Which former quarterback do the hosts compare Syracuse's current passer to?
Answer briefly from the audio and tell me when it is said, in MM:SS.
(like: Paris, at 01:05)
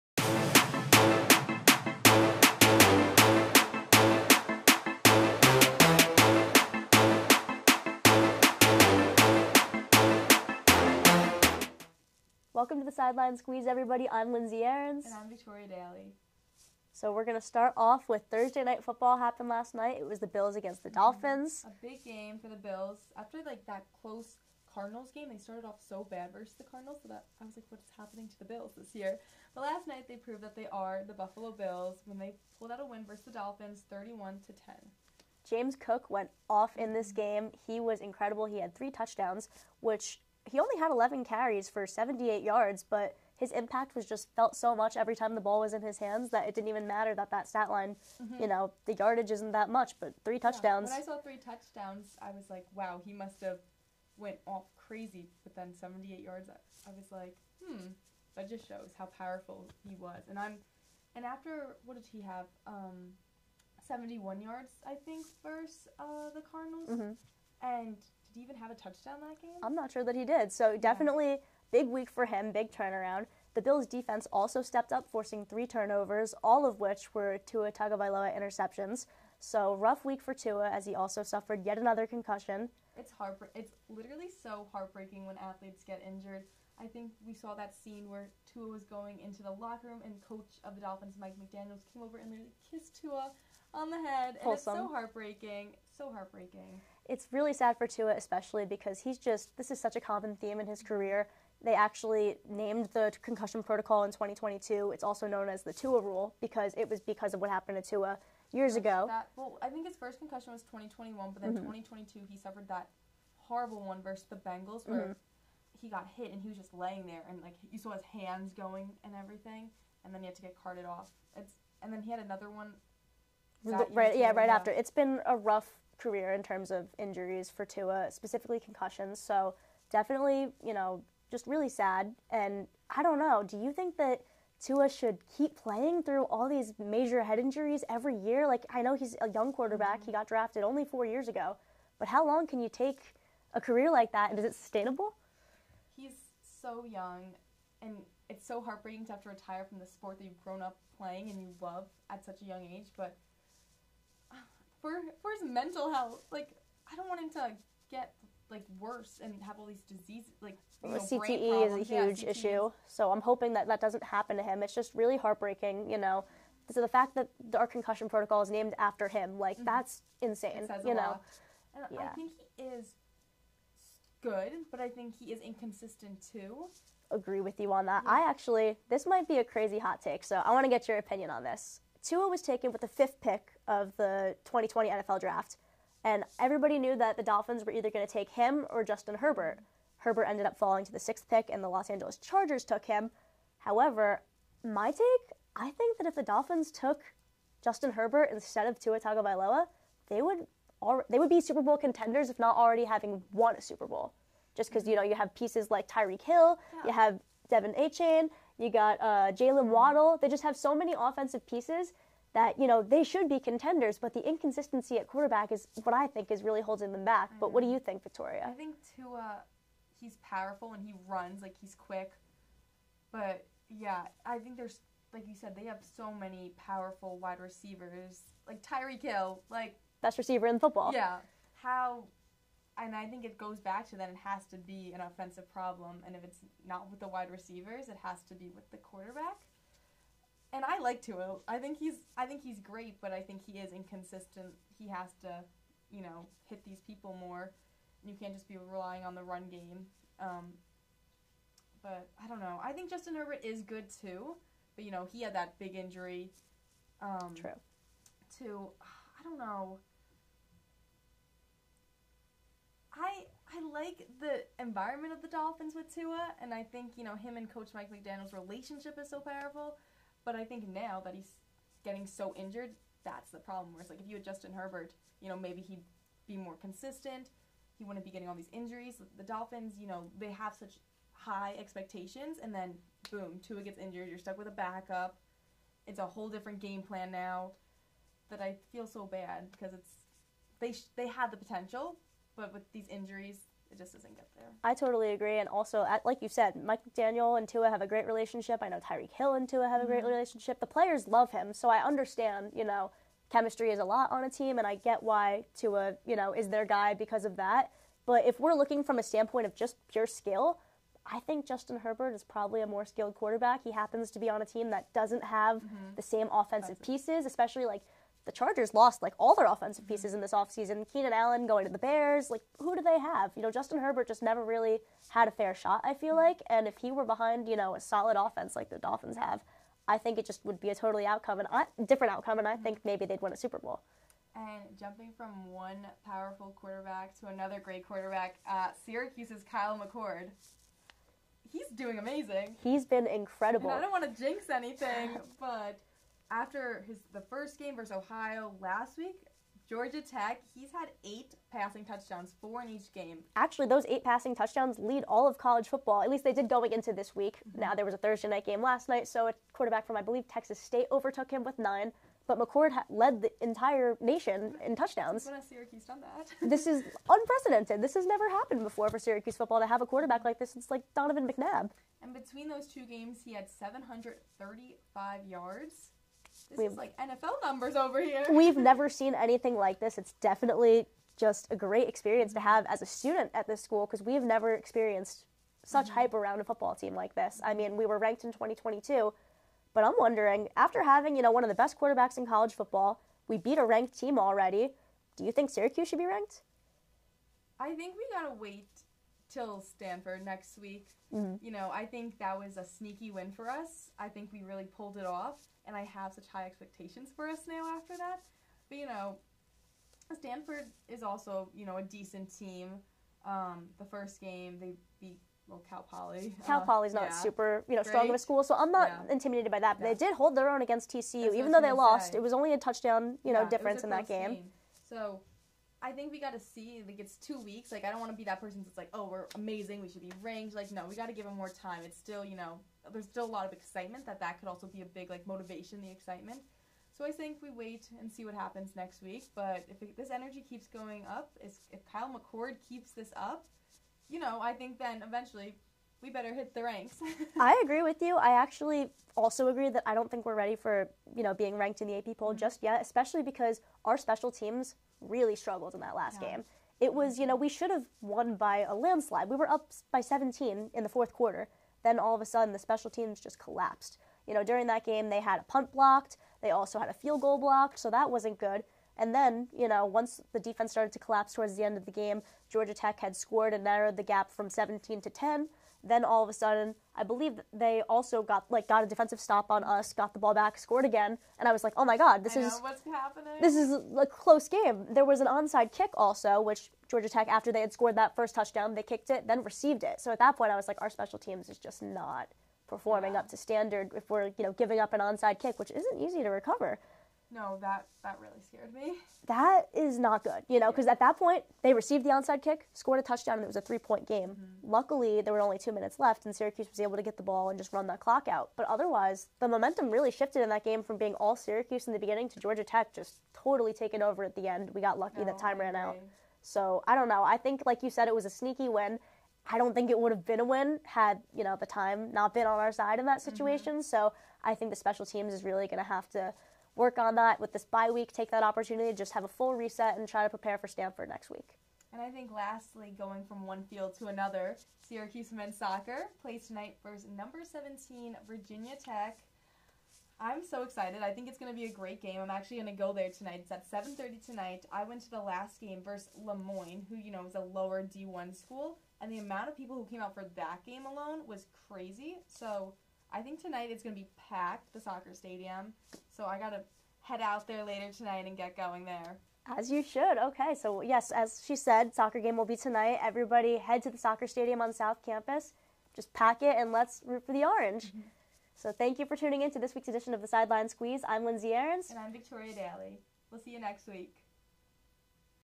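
Donovan McNabb, at 06:10.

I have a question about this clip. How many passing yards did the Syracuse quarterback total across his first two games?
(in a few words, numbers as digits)
735.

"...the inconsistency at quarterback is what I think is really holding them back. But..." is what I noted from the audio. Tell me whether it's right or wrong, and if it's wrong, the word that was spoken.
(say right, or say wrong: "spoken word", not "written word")
right.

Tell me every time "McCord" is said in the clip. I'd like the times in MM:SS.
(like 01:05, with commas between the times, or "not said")
05:39, 06:02, 07:22.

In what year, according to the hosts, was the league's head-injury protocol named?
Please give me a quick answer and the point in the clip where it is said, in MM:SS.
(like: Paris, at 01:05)
2022, at 01:43.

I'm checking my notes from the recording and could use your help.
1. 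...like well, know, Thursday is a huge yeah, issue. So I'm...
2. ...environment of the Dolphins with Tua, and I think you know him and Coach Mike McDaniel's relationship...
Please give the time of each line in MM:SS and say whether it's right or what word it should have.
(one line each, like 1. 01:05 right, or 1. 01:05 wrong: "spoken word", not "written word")
1. 02:40 wrong: "CTE", not "Thursday"
2. 04:24 right.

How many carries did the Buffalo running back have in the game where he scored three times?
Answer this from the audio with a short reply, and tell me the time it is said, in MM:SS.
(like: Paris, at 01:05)
11, at 00:40.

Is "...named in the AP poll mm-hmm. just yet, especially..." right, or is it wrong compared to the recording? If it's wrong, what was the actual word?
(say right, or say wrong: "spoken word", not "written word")
wrong: "ranked", not "named".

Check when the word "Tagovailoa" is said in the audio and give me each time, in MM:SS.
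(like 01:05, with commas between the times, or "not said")
01:17, 03:19.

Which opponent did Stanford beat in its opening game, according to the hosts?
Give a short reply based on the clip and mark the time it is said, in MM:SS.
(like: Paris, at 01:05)
Cal Poly, at 06:55.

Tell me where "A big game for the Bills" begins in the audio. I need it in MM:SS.
00:21.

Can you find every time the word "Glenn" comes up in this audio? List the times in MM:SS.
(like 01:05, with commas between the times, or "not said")
not said.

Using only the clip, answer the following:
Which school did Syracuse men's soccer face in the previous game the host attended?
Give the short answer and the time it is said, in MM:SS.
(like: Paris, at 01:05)
Le Moyne, at 09:06.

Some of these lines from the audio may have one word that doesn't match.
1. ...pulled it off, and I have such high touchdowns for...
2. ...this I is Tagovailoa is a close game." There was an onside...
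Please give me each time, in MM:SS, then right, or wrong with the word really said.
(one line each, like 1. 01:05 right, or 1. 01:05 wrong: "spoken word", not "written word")
1. 06:44 wrong: "expectations", not "touchdowns"
2. 08:02 wrong: "This", not "Tagovailoa".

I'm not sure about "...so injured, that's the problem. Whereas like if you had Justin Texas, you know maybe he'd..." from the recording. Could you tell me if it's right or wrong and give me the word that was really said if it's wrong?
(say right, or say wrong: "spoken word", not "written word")
wrong: "Herbert", not "Texas".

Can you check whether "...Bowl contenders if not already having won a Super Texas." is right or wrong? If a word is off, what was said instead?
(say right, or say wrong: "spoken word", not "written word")
wrong: "Bowl", not "Texas".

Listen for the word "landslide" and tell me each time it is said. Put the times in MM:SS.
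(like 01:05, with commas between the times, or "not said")
07:38.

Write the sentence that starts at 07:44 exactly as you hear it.
You know, during that game, they had a punt blocked.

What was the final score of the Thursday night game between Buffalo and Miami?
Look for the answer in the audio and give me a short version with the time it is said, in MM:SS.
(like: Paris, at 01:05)
31 to 10, at 00:33.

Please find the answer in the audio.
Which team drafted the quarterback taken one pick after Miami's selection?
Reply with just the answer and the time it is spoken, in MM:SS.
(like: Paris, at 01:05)
Los Angeles Chargers, at 03:11.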